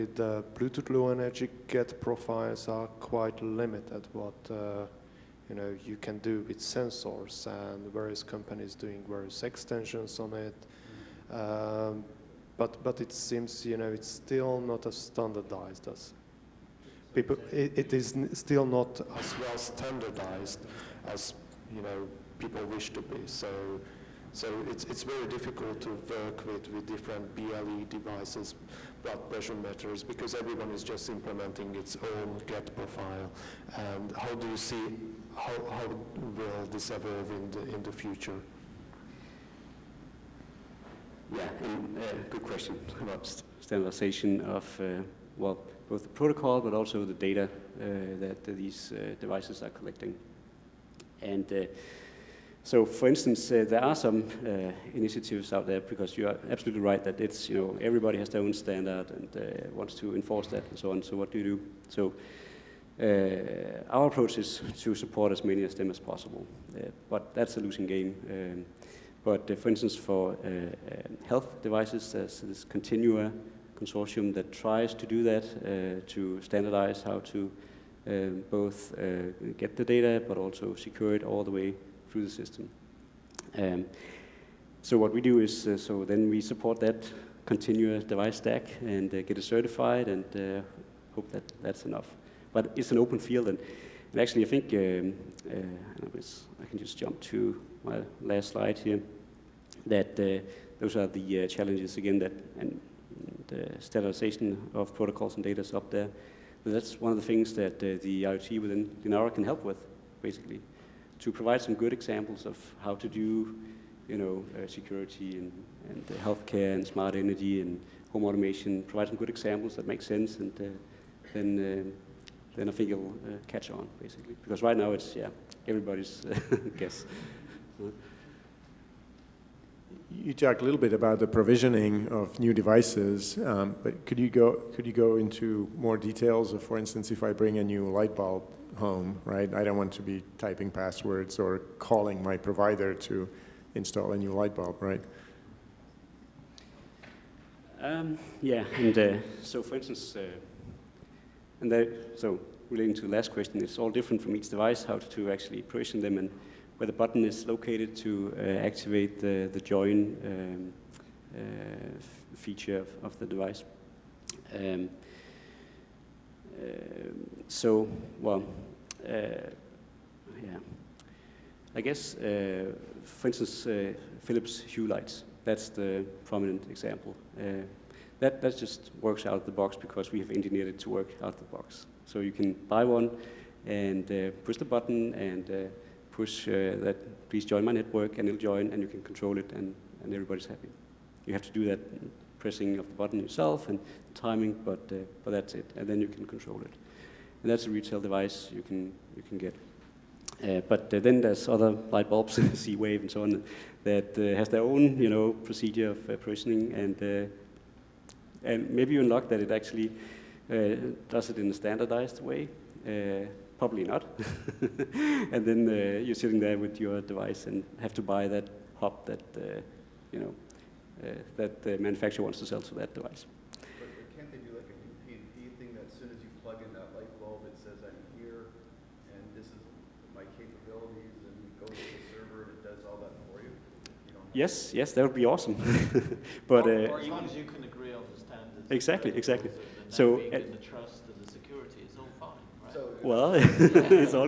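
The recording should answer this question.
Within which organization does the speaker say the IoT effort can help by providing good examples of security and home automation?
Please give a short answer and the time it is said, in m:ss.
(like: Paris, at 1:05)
Linaro, at 1:49.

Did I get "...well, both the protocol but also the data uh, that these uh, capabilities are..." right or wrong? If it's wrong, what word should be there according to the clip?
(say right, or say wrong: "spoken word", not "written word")
wrong: "devices", not "capabilities".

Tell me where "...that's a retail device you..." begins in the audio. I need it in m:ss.
3:17.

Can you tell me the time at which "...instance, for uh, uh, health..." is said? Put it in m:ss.
1:09.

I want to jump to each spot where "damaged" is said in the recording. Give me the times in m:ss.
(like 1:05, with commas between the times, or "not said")
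not said.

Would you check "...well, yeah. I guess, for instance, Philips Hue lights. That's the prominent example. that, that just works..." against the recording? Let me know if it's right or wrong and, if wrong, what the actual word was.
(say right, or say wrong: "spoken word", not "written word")
right.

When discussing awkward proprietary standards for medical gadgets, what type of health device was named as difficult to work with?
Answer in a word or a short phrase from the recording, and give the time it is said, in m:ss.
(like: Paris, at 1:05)
Blood pressure meters, at 0:29.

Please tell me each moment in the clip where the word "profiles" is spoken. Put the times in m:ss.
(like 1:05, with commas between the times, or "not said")
0:02, 0:32.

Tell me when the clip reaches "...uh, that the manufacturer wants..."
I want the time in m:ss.
3:41.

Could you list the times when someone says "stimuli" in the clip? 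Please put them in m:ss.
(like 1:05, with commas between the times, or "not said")
not said.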